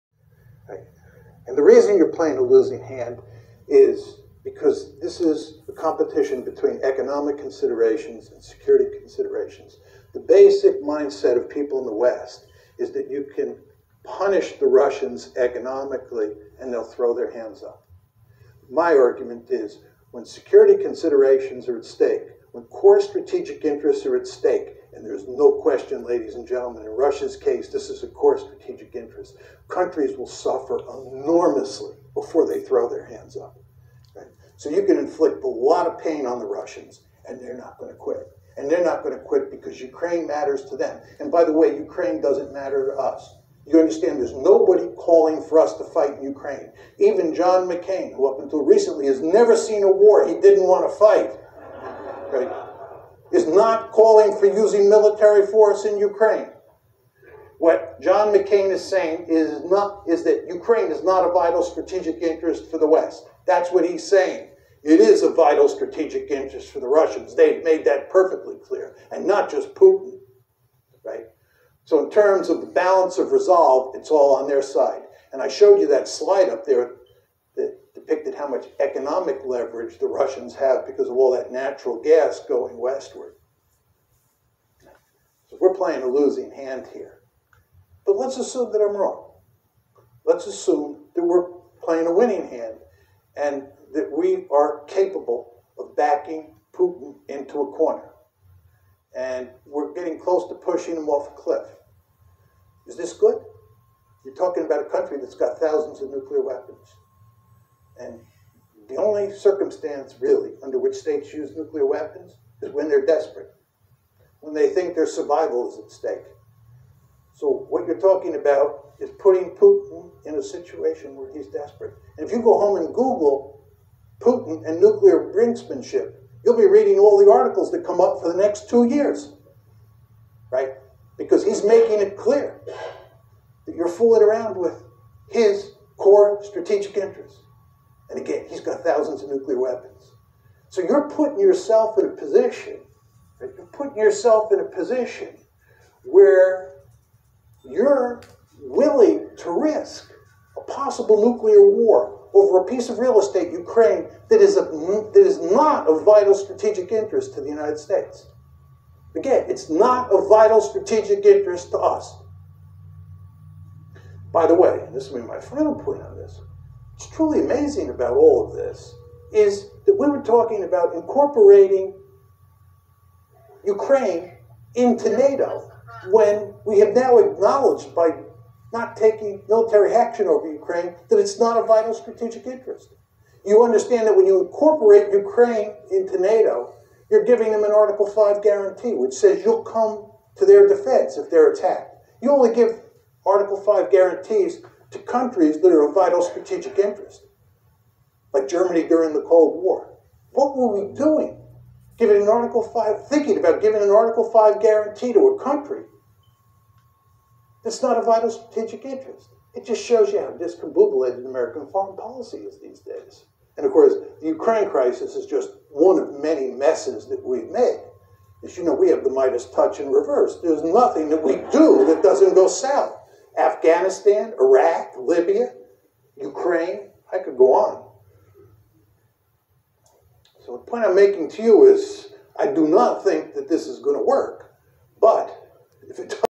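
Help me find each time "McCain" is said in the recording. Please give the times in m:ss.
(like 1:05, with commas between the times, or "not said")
0:47, 0:58.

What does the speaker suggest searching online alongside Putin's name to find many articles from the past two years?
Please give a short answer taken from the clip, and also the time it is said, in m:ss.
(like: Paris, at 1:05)
Nuclear brinksmanship, at 2:04.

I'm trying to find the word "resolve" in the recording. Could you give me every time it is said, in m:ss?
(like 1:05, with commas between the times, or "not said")
1:13.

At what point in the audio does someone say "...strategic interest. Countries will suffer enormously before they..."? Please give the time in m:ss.
0:28.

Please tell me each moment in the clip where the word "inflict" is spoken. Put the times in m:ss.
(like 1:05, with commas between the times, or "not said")
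0:34.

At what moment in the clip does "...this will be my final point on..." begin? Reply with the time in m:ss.
2:44.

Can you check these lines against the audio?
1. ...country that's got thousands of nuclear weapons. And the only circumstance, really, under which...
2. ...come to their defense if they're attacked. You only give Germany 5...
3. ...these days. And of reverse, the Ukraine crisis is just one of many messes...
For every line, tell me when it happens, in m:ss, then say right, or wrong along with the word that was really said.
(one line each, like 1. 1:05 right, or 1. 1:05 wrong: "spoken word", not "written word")
1. 1:44 right
2. 3:09 wrong: "Article", not "Germany"
3. 3:32 wrong: "course", not "reverse".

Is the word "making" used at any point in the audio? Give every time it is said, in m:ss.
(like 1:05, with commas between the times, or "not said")
2:11, 3:50.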